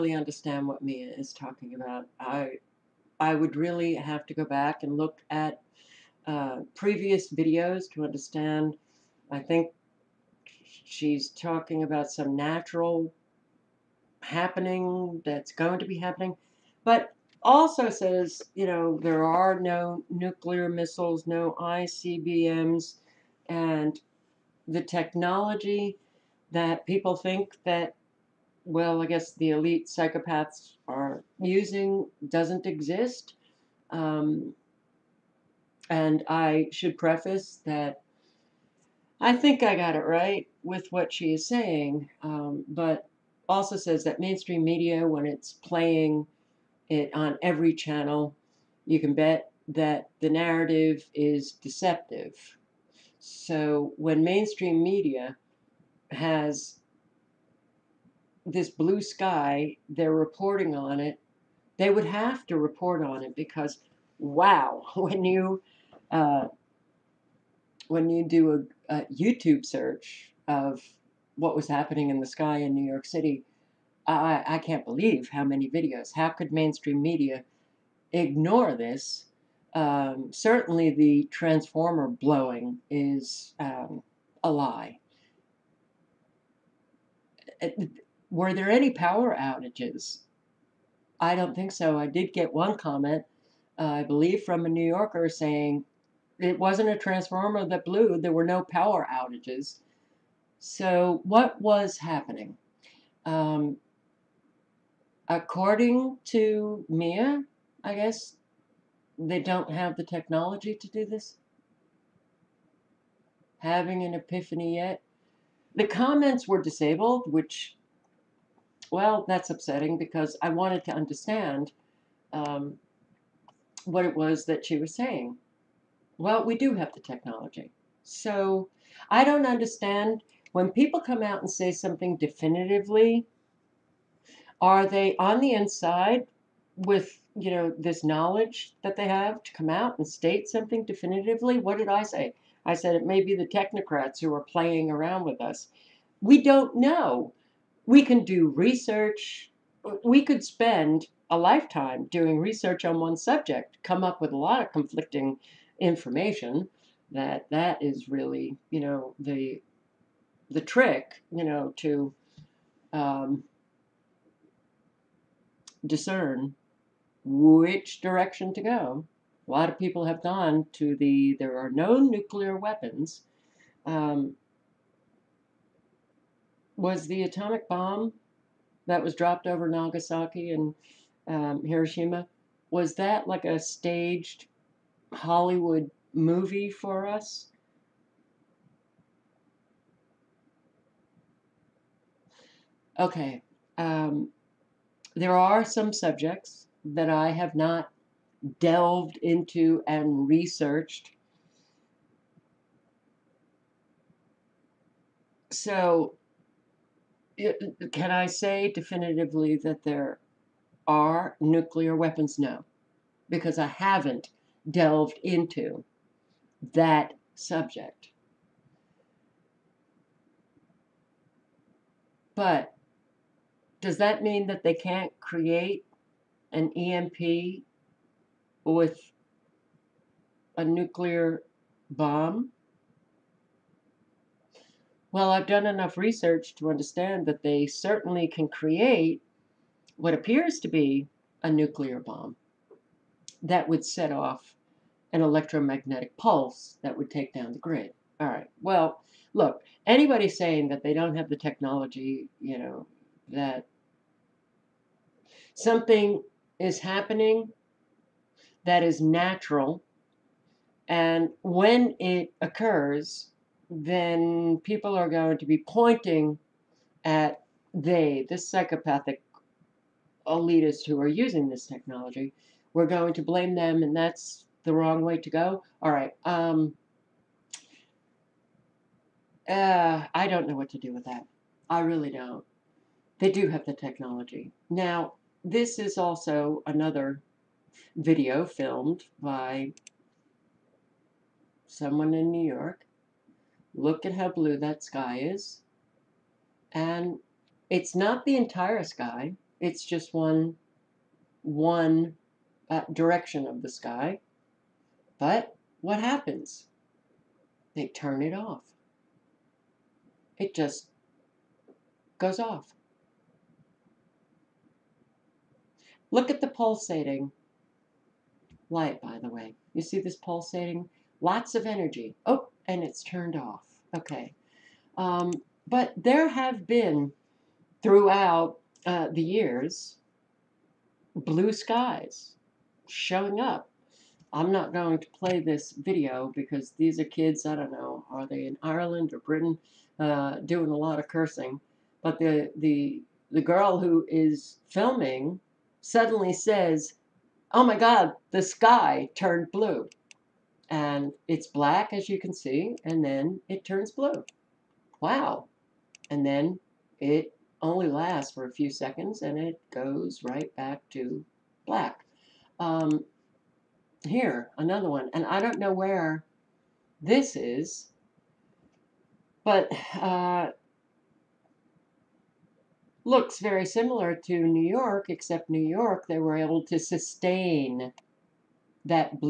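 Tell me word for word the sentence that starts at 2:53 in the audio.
Um, was the atomic bomb that was dropped over Nagasaki and um, Hiroshima, was that like a staged Hollywood movie for us?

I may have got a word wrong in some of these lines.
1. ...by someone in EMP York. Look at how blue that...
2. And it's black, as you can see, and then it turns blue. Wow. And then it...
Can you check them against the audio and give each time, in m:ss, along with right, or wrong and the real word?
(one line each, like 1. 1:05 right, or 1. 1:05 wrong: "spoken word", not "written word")
1. 4:49 wrong: "New", not "EMP"
2. 5:50 right.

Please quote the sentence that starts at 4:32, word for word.
We're going to blame them, and that's the wrong way to go.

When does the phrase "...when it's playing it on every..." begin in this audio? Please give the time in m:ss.
0:45.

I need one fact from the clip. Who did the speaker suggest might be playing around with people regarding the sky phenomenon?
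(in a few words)
Technocrats.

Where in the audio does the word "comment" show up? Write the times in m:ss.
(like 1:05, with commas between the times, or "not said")
1:32, 1:55.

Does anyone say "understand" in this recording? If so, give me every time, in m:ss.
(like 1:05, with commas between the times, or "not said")
0:00, 0:08, 2:00, 2:09, 3:56.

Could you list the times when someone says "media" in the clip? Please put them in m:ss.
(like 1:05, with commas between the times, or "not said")
0:44, 0:54, 1:17.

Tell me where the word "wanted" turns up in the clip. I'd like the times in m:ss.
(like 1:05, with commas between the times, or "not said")
2:00.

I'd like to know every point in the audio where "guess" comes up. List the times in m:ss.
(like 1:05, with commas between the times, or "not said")
0:29, 1:47.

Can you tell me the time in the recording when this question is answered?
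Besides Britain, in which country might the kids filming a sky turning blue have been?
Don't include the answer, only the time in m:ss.
5:38.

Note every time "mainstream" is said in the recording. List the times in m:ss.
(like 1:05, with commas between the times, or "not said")
0:44, 0:54, 1:16.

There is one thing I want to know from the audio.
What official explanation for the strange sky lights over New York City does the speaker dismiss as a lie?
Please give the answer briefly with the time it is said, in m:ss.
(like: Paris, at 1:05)
Transformer blowing, at 1:20.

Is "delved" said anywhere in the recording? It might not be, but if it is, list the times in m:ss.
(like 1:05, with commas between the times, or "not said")
3:18, 3:34.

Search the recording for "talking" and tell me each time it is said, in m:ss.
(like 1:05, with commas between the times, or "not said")
0:01, 0:11.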